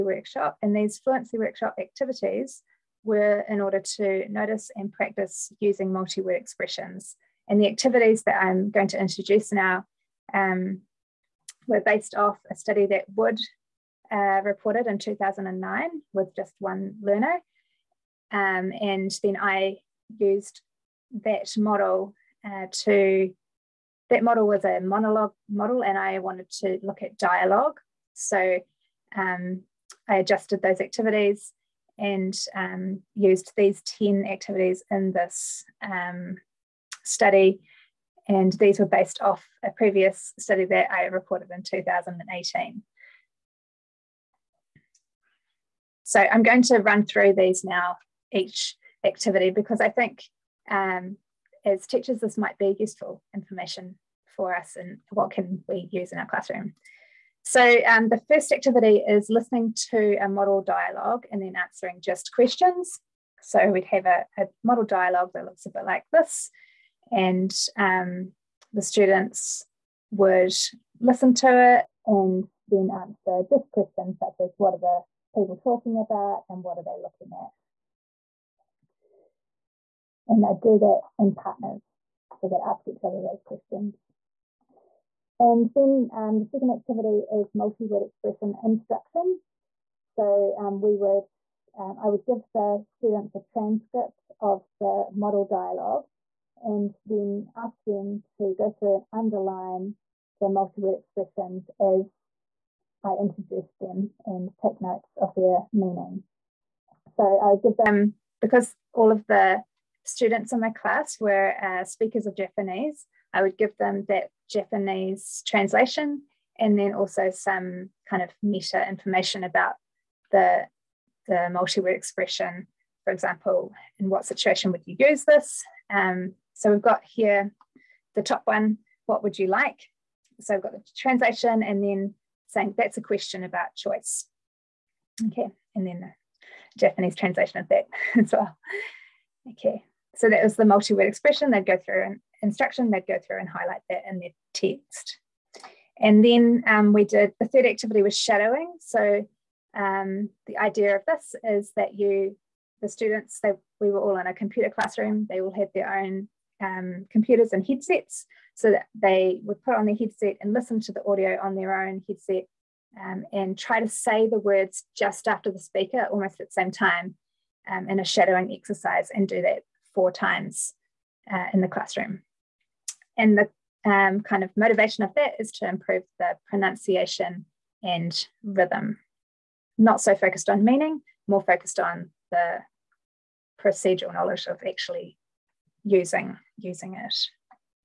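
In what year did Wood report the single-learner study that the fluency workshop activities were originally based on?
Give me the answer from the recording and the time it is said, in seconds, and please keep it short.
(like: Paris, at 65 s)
2009, at 14 s.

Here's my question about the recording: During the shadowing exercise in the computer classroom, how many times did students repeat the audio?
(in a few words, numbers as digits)
4.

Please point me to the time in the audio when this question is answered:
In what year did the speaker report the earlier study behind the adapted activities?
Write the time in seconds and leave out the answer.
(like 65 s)
41 s.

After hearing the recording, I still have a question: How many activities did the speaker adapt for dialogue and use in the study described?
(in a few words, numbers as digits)
10.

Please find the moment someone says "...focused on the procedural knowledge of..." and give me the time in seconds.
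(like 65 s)
181 s.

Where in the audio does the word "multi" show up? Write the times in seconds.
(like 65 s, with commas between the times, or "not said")
5 s, 87 s, 100 s, 121 s, 140 s.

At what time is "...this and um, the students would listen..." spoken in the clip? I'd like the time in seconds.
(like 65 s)
66 s.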